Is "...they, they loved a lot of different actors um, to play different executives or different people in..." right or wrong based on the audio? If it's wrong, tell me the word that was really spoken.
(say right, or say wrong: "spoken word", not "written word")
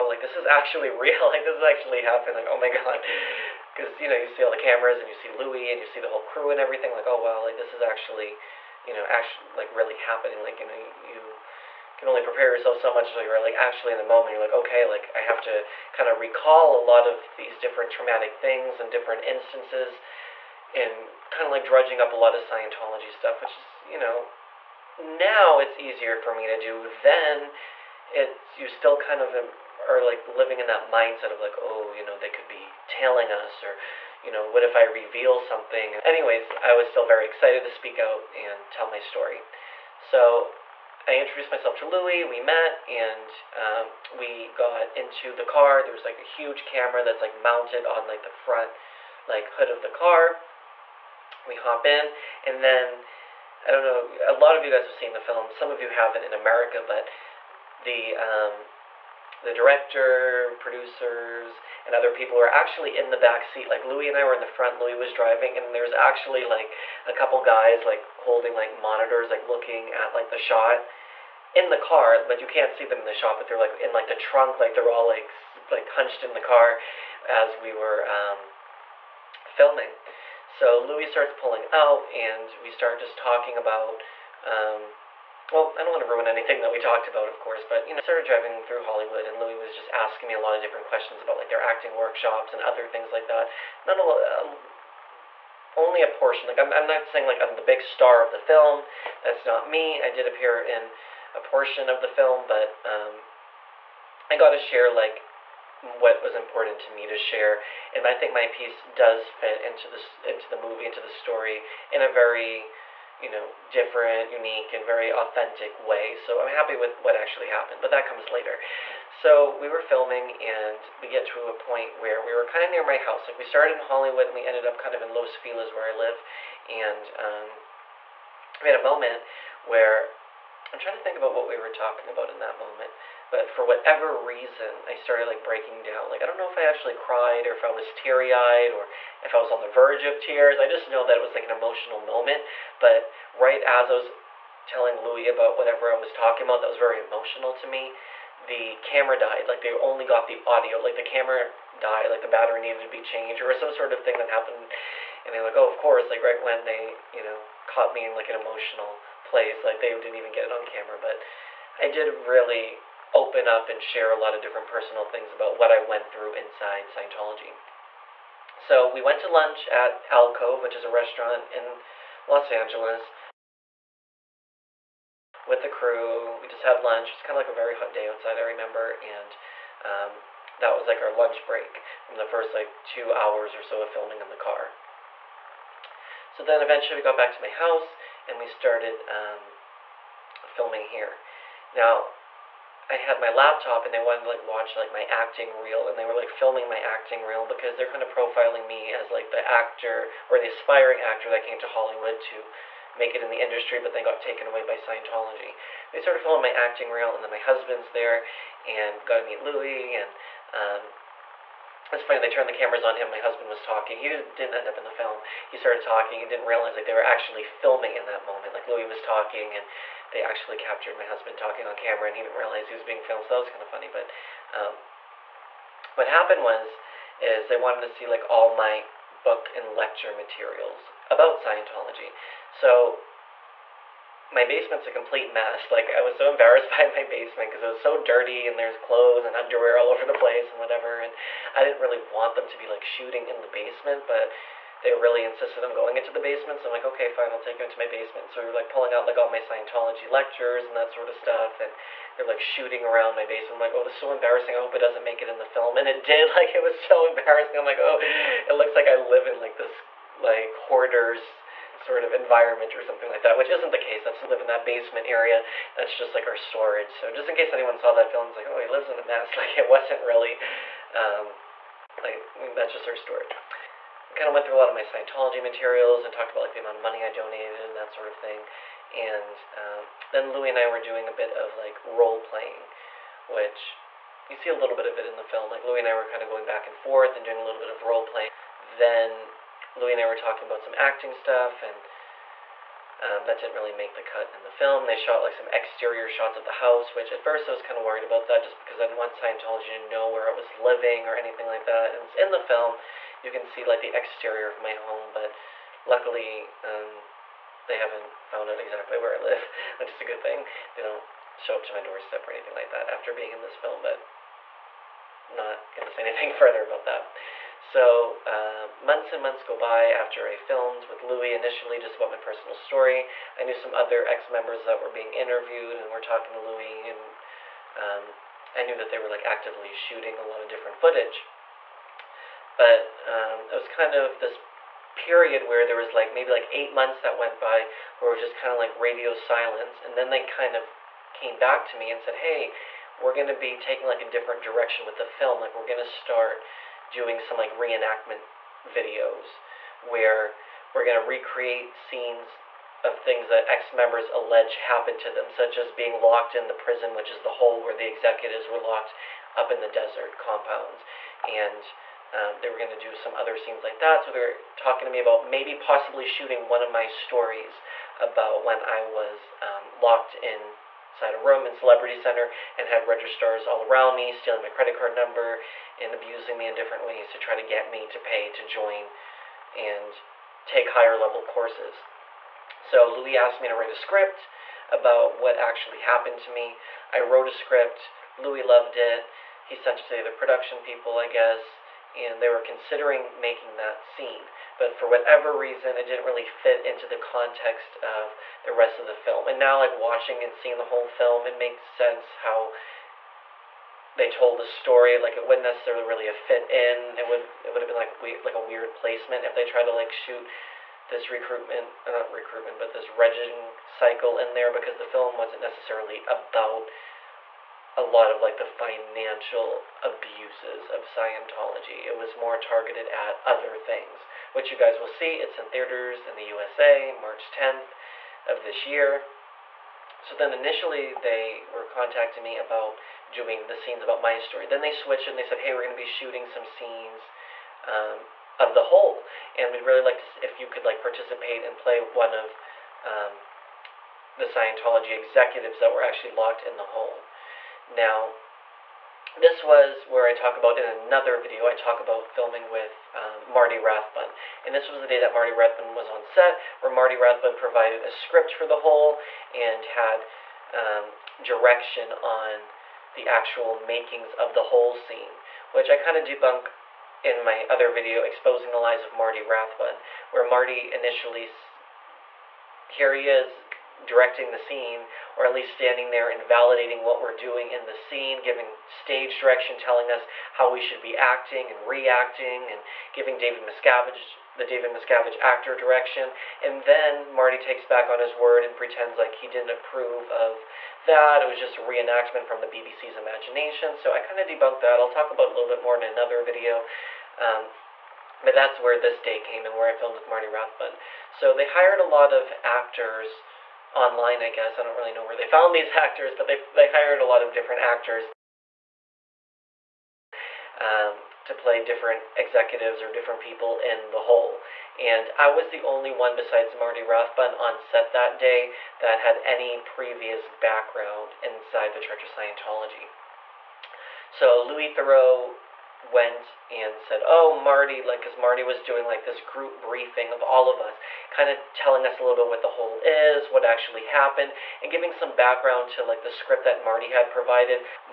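wrong: "hired", not "loved".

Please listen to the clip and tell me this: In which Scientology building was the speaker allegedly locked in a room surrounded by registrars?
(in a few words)
Celebrity Center.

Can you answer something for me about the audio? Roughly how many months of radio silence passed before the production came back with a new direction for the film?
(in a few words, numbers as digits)
8.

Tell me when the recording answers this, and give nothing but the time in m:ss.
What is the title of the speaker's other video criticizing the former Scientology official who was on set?
7:48.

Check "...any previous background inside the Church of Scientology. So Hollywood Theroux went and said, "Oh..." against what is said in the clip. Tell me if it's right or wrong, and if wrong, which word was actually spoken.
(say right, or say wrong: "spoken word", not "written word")
wrong: "Louis", not "Hollywood".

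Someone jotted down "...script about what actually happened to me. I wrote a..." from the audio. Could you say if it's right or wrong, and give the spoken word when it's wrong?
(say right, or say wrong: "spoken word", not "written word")
right.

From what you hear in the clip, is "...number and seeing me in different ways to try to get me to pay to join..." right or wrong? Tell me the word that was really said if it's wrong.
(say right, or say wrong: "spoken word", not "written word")
wrong: "abusing", not "seeing".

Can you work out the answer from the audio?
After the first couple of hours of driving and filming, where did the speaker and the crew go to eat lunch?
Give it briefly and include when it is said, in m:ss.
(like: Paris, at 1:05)
Alcove, at 2:50.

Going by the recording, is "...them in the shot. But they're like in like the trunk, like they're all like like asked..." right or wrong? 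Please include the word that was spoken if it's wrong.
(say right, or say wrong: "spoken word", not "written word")
wrong: "hunched", not "asked".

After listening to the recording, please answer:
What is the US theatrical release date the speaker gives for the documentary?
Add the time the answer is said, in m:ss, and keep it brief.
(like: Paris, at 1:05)
March 10, at 7:06.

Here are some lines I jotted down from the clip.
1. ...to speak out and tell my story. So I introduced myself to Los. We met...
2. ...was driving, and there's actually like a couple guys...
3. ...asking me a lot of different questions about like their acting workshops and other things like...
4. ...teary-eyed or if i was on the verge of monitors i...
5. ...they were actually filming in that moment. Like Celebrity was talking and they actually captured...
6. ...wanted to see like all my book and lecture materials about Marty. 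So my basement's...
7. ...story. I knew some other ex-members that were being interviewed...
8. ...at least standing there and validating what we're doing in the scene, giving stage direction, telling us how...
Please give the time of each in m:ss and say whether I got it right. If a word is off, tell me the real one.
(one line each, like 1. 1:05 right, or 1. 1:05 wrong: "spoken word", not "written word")
1. 0:37 wrong: "Louis", not "Los"
2. 1:04 right
3. 1:29 right
4. 2:17 wrong: "tears", not "monitors"
5. 3:36 wrong: "Louis", not "Celebrity"
6. 3:47 wrong: "Scientology", not "Marty"
7. 5:22 right
8. 7:55 right.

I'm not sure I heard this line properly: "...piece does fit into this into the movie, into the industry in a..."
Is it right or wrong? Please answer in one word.
wrong.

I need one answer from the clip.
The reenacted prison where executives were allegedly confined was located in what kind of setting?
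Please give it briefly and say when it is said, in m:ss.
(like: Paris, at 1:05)
desert compounds, at 5:59.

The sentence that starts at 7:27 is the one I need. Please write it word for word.
Now, this was where I talk about in another video, I talk about filming with um, Marty Rathbun.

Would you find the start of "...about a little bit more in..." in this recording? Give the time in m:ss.
8:15.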